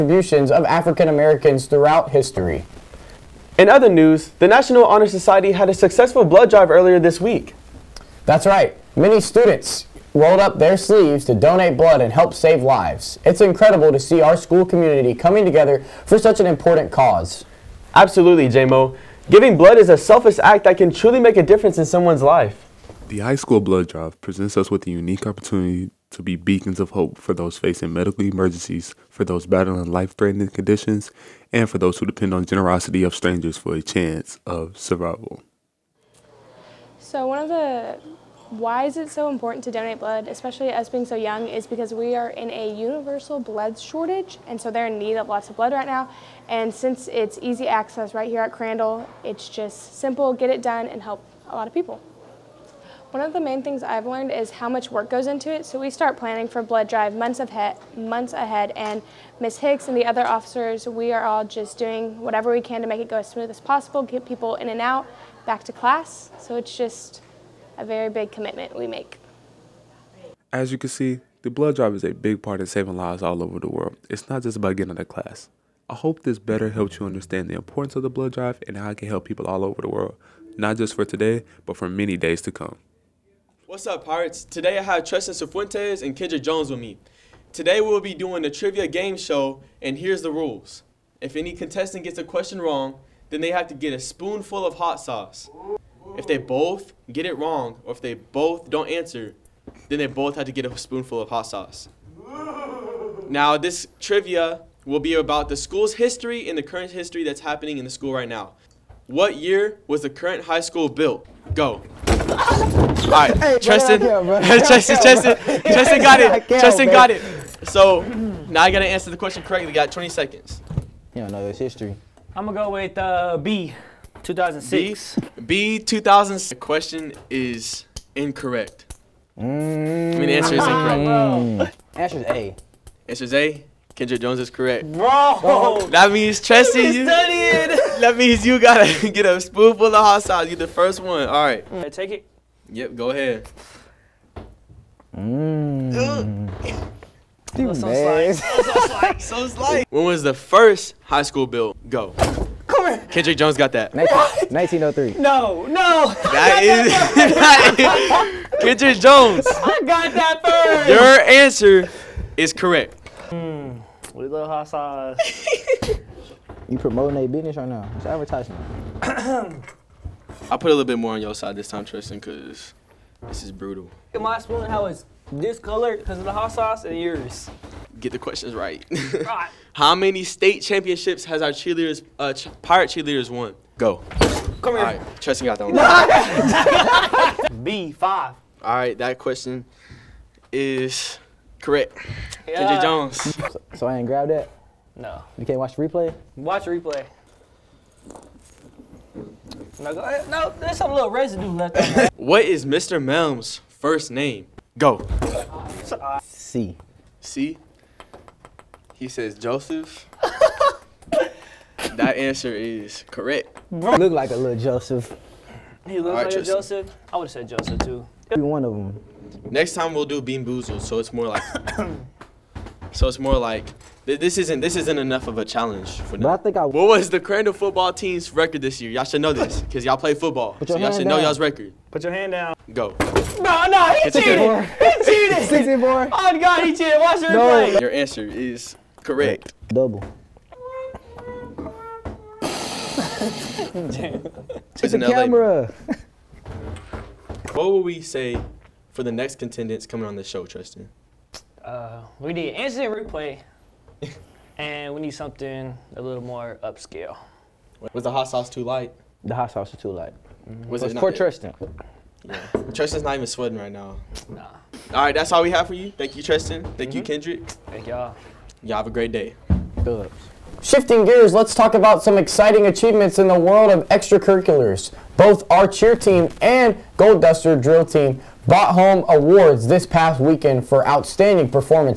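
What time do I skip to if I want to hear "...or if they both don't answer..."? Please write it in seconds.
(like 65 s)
97 s.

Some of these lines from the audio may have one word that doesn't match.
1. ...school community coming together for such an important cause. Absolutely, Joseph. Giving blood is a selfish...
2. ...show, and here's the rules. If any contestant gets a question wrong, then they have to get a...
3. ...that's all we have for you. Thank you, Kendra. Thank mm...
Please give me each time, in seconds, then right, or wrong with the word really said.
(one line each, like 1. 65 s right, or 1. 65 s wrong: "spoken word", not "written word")
1. 14 s wrong: "JMO", not "Joseph"
2. 89 s right
3. 265 s wrong: "Tristan", not "Kendra".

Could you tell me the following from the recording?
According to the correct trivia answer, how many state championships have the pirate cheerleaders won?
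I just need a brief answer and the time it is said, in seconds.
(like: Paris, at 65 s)
5, at 187 s.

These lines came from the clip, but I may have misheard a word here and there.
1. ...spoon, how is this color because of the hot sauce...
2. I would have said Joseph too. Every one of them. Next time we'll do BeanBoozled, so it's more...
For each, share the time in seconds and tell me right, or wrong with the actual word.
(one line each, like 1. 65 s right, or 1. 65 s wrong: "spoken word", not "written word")
1. 174 s right
2. 217 s right.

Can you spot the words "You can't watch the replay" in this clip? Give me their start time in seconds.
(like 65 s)
195 s.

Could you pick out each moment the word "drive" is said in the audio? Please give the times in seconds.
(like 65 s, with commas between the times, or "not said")
6 s, 23 s, 56 s, 71 s, 78 s.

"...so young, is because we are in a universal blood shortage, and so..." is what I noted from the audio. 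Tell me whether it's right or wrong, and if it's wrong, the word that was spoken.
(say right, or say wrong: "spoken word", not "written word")
right.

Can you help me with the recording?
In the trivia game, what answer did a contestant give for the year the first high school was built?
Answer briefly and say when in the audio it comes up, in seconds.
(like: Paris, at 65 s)
1903, at 153 s.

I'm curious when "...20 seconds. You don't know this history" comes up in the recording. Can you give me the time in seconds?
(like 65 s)
119 s.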